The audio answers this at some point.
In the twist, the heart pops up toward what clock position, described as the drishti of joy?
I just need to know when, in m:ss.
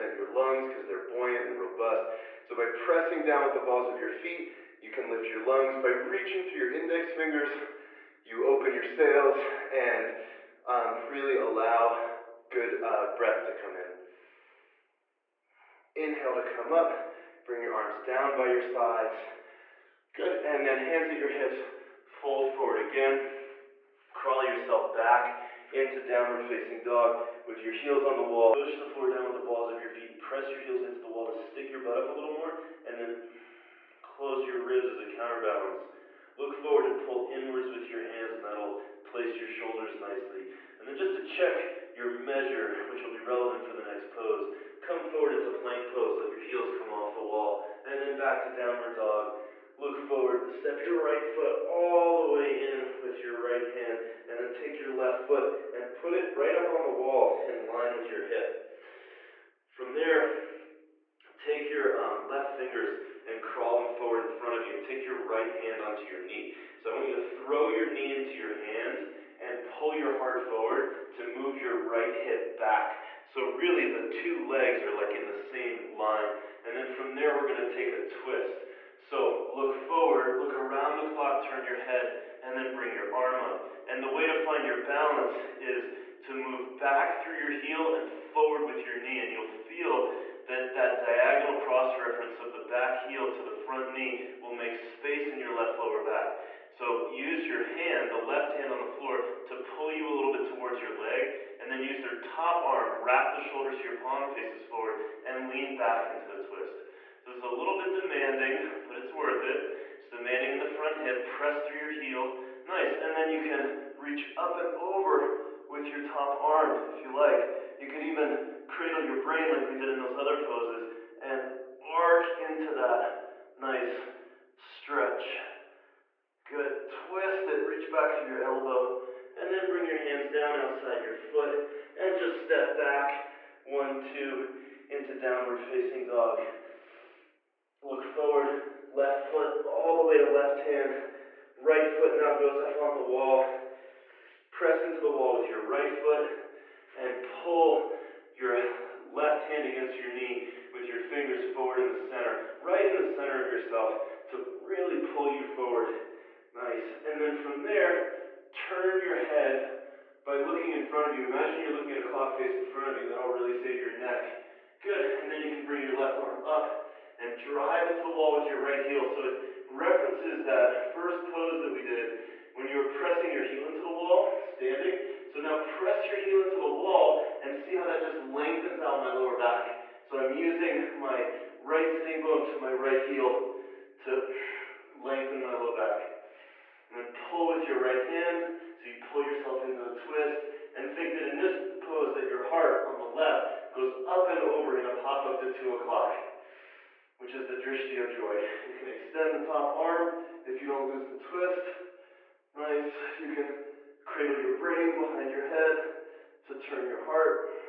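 3:15.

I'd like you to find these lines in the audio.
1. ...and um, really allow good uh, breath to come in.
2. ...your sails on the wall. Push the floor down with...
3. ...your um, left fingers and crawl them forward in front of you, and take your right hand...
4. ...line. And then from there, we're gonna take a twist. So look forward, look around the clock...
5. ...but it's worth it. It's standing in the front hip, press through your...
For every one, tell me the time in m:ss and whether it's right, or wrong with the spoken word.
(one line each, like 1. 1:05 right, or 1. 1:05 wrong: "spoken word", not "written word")
1. 0:09 right
2. 0:27 wrong: "heels", not "sails"
3. 1:01 right
4. 1:15 right
5. 1:48 wrong: "demanding", not "standing".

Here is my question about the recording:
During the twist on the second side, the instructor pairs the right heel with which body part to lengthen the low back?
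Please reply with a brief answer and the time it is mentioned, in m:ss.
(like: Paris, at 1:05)
right sitting bone, at 3:01.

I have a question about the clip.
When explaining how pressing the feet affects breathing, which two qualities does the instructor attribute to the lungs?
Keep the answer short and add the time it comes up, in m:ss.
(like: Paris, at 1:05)
buoyant and robust, at 0:01.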